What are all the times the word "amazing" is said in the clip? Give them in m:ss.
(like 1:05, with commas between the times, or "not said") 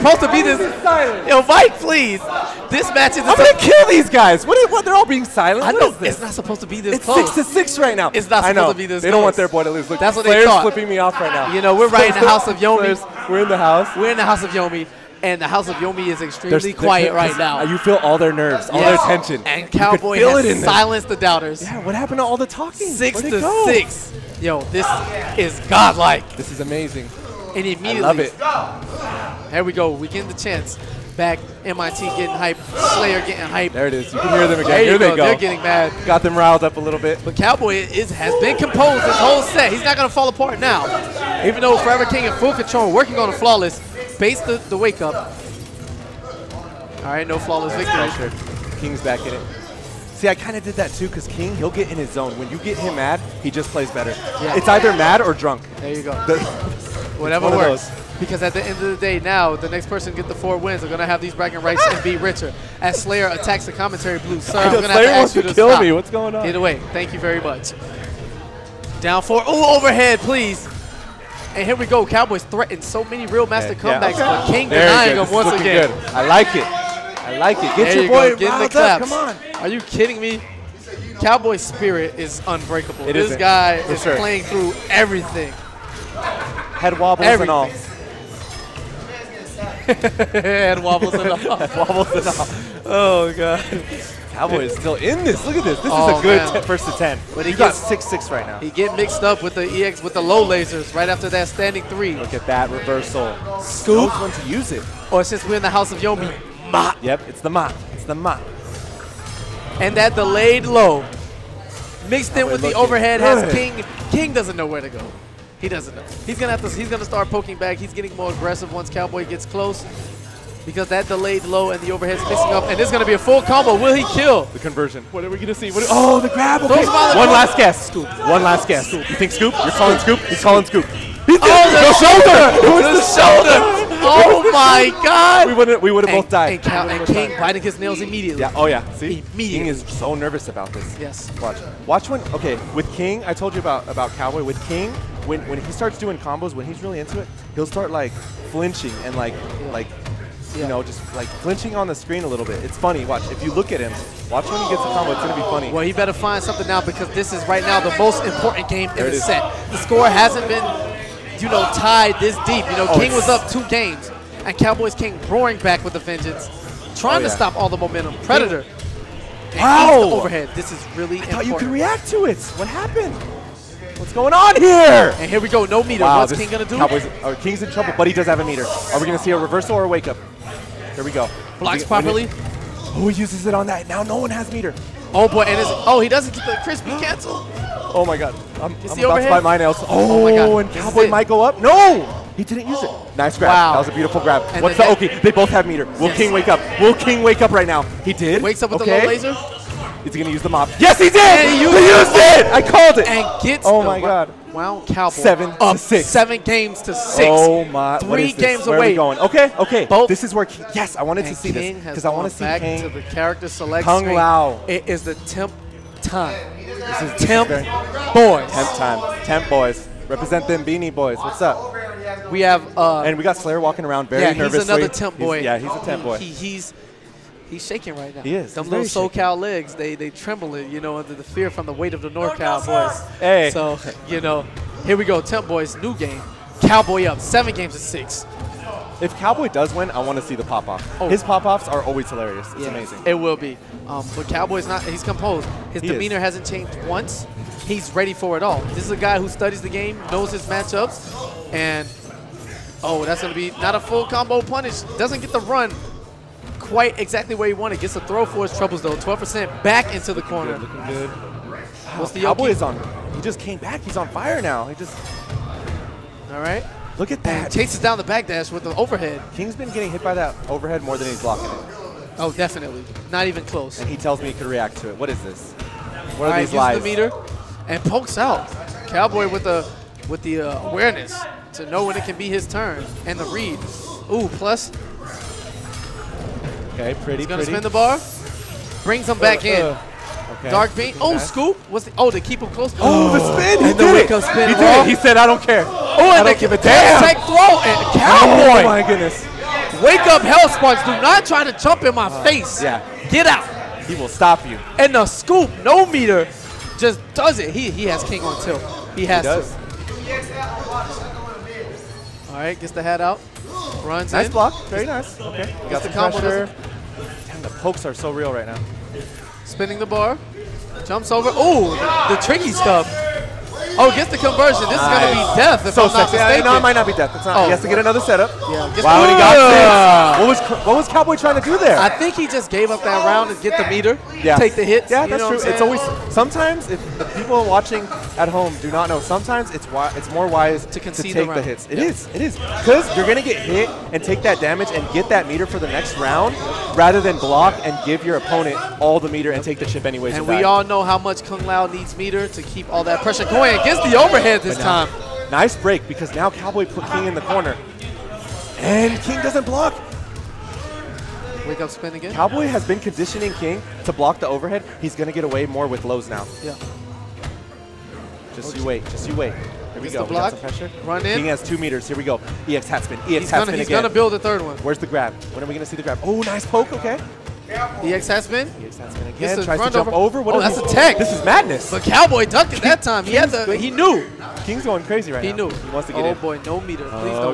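0:26, 4:02.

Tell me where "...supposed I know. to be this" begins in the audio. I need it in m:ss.
0:08.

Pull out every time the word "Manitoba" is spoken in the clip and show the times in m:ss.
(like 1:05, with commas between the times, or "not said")
not said.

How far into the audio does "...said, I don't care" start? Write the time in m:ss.
4:54.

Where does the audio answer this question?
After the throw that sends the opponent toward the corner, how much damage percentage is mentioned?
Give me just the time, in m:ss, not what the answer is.
4:18.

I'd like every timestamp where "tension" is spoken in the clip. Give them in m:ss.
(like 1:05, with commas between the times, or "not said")
0:19.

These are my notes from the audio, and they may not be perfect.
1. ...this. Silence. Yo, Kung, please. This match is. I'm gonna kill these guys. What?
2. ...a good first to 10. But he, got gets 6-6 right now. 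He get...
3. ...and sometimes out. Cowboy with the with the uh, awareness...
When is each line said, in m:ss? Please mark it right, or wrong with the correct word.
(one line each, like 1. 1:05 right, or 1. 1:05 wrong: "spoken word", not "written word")
1. 0:00 wrong: "Mike", not "Kung"
2. 1:36 right
3. 4:37 wrong: "pokes", not "sometimes".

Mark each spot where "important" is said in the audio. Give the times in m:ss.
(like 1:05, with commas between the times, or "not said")
2:38, 2:51.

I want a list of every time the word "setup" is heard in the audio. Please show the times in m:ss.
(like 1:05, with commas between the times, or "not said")
5:28.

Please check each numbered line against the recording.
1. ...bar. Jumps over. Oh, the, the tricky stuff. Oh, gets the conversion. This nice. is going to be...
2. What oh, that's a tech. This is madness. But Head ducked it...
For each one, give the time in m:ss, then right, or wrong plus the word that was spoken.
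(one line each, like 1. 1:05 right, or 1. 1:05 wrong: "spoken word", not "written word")
1. 5:19 right
2. 6:20 wrong: "Cowboy", not "Head".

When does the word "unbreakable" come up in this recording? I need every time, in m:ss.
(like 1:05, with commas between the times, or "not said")
1:22.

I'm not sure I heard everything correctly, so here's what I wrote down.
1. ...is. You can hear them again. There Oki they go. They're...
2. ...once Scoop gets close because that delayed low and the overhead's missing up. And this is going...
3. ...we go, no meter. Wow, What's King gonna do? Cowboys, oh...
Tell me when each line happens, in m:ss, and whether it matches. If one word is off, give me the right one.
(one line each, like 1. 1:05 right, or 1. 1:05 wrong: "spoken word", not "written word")
1. 0:33 wrong: "Here", not "Oki"
2. 1:58 wrong: "Cowboy", not "Scoop"
3. 2:55 right.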